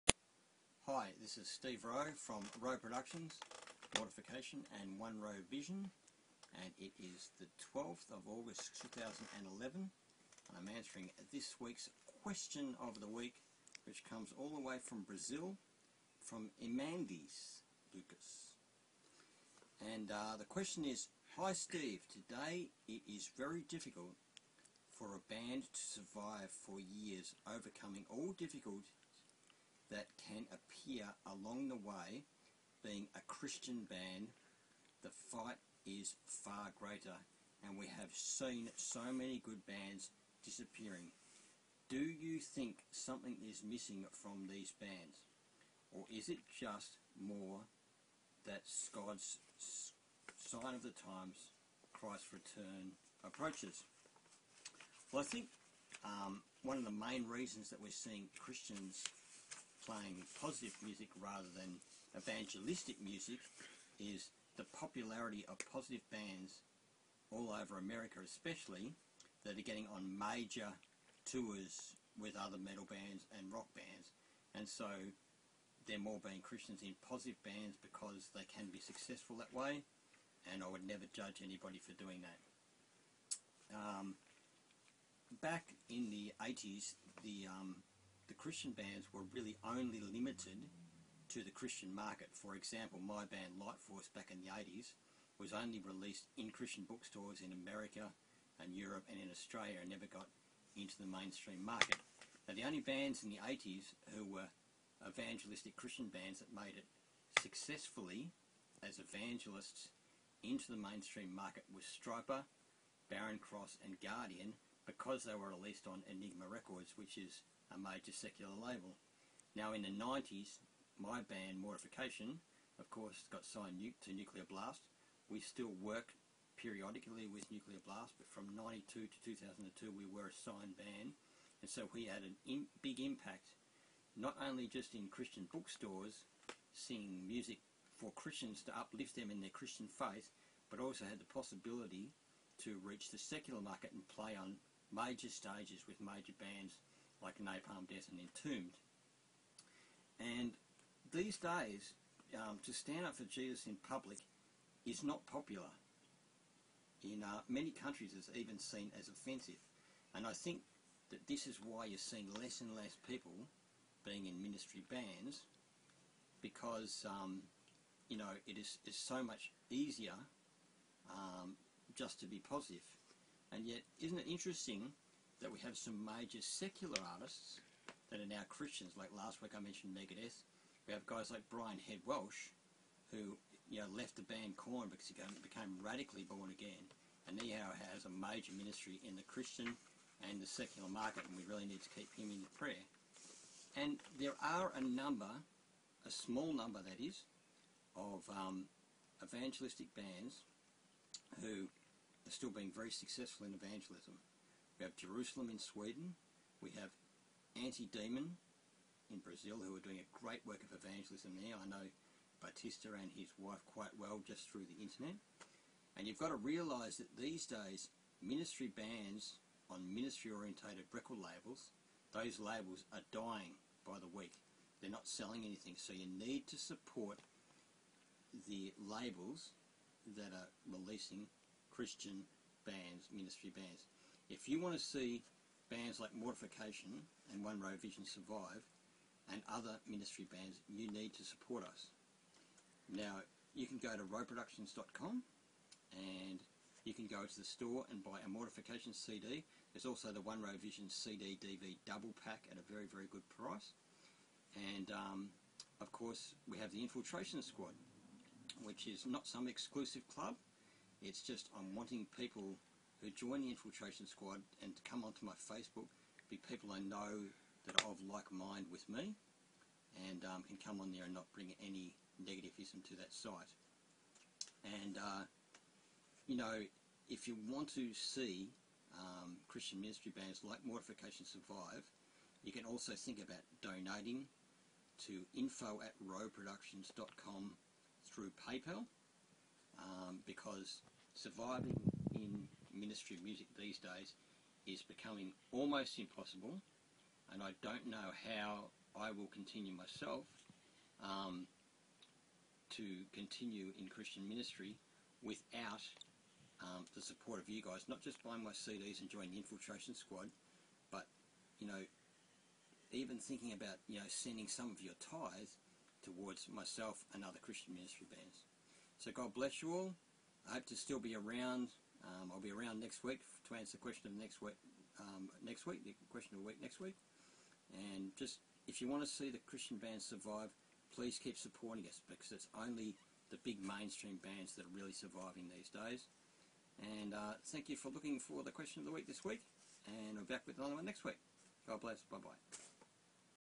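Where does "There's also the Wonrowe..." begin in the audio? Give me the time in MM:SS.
04:09.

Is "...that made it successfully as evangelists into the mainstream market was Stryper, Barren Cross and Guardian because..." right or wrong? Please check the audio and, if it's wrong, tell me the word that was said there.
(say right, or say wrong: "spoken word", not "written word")
right.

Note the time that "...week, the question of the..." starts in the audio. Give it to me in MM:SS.
05:25.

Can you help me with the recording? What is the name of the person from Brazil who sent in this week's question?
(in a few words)
Emandis Lucas.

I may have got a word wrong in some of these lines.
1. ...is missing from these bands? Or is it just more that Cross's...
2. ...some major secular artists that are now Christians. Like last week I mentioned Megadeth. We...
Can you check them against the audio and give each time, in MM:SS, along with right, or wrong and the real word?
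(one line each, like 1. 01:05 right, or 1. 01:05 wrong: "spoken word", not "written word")
1. 00:43 wrong: "God", not "Cross"
2. 02:55 right.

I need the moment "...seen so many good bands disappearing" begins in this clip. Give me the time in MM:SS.
00:38.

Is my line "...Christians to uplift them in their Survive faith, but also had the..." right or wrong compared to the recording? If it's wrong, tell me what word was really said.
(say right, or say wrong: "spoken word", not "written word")
wrong: "Christian", not "Survive".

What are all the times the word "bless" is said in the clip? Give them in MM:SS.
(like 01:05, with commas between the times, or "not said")
05:19, 05:41.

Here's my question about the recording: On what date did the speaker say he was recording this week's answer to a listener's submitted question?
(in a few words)
12 August 2011.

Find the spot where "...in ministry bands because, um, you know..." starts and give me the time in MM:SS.
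02:44.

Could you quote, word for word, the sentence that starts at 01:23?
Um, back in the 80s the um, the Christian bands were really only limited to the Christian market.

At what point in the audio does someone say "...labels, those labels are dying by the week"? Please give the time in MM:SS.
03:41.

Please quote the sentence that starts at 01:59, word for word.
Now in the 90s, my band Mortification, of course, got signed to Nuclear Blast.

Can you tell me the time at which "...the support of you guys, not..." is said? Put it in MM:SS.
05:06.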